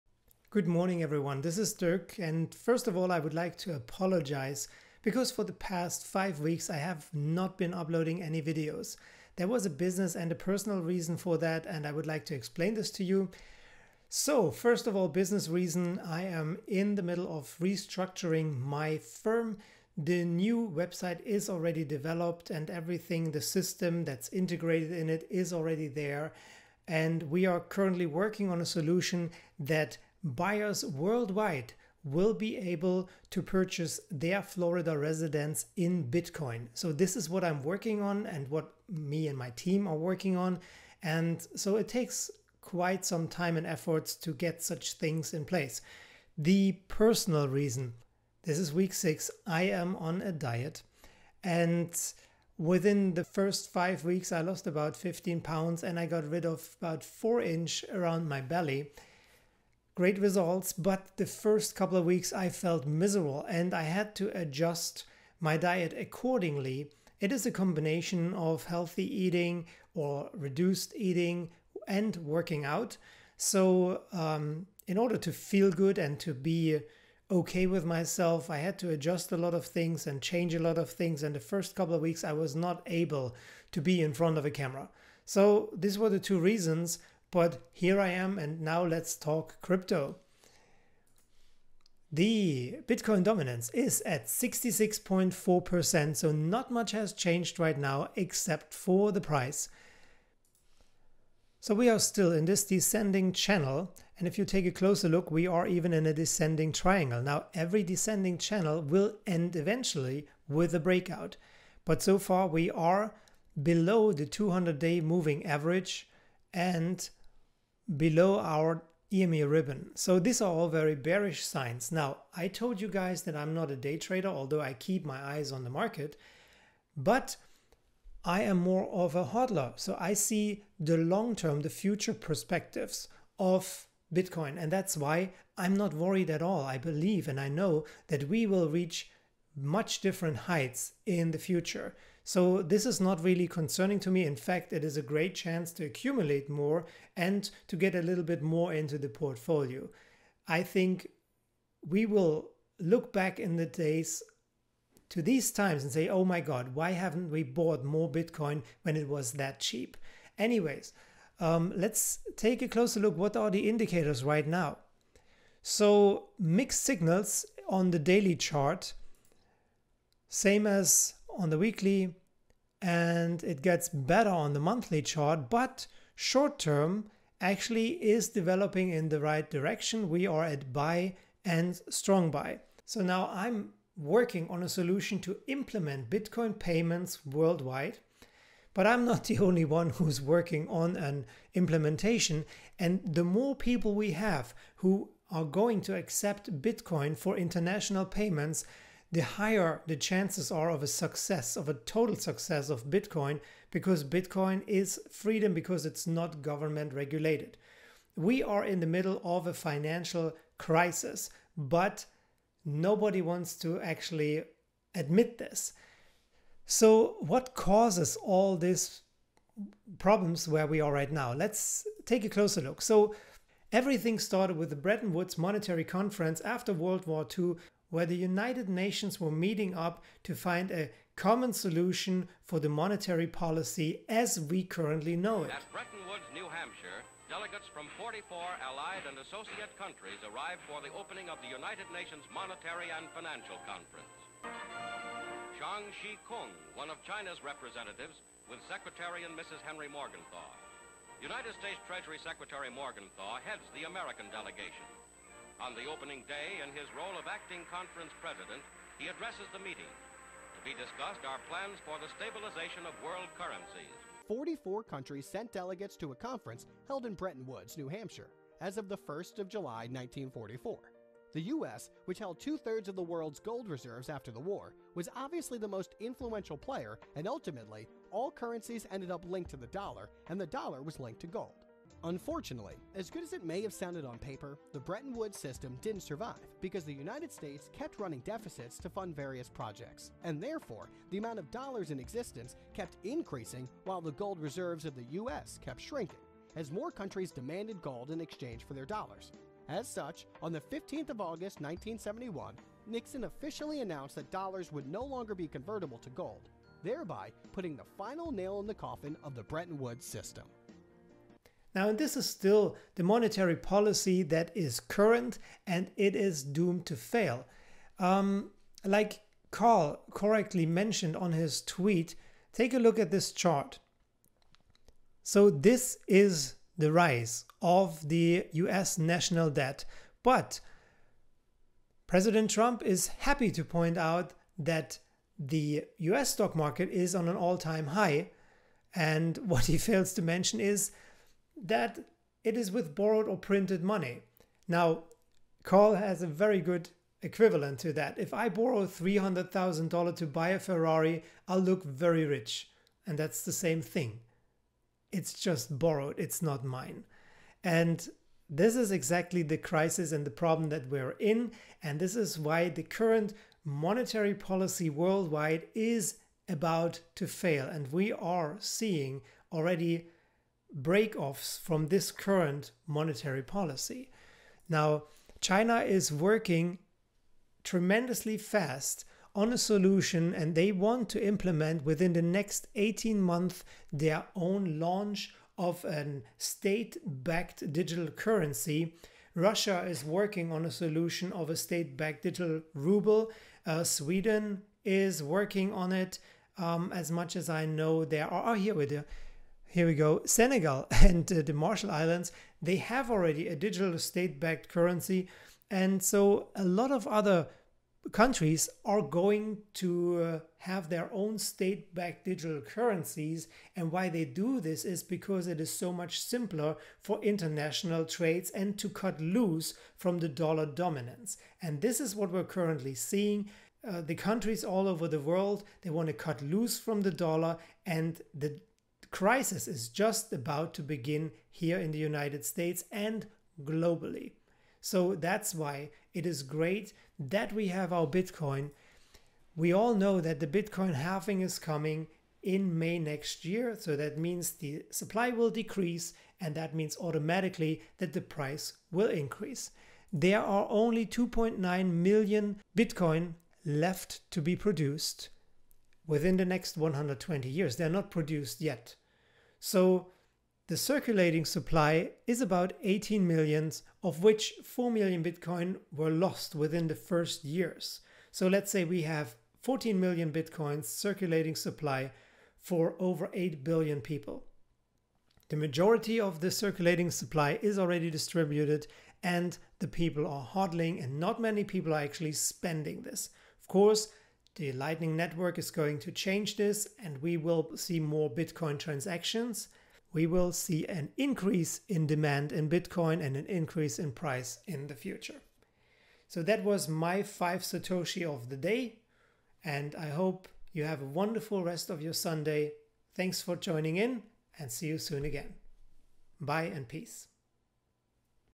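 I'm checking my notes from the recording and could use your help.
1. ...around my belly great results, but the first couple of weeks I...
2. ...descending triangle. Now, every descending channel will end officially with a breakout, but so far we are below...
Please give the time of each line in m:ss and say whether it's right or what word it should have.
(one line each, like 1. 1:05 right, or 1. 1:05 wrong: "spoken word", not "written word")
1. 0:57 right
2. 1:46 wrong: "eventually", not "officially".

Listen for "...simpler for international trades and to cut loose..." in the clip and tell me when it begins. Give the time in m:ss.
6:56.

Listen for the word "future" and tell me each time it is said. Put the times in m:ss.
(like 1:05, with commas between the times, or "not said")
2:11, 2:21, 8:14.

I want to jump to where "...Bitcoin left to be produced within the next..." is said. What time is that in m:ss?
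7:32.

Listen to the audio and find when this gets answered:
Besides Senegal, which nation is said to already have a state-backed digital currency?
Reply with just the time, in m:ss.
6:41.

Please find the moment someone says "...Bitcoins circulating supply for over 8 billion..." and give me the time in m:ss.
7:50.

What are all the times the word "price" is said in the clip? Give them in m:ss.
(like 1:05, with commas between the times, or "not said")
1:39, 7:28, 8:14.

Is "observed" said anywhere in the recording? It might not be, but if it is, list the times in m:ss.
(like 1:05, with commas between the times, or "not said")
not said.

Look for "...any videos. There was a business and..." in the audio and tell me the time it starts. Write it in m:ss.
0:08.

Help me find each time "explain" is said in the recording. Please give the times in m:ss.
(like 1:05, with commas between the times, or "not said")
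0:12.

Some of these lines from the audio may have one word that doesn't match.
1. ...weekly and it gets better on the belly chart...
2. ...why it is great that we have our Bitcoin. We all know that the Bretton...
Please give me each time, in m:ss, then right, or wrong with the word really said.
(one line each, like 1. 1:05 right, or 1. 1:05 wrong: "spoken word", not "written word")
1. 2:51 wrong: "monthly", not "belly"
2. 7:15 wrong: "Bitcoin", not "Bretton".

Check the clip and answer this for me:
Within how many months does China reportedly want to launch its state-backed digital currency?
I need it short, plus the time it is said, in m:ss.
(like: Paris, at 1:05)
18 months, at 6:22.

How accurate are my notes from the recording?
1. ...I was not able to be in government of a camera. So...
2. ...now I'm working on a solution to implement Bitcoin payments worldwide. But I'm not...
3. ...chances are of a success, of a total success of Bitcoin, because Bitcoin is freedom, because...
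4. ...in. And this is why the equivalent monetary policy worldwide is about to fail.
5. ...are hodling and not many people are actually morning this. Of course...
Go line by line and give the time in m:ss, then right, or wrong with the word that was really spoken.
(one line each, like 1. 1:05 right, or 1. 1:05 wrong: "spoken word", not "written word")
1. 1:22 wrong: "front", not "government"
2. 3:03 right
3. 3:19 right
4. 6:01 wrong: "current", not "equivalent"
5. 8:00 wrong: "spending", not "morning".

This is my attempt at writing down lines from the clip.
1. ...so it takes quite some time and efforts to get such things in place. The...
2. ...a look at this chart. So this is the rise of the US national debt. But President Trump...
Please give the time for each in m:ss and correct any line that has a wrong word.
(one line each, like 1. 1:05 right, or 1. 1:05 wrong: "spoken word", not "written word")
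1. 0:41 right
2. 5:22 right.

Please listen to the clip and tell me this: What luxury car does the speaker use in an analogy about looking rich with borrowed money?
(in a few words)
Ferrari.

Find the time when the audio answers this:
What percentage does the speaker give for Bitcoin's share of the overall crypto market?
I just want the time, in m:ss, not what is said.
1:34.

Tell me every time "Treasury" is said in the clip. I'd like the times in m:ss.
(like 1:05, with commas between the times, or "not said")
4:11.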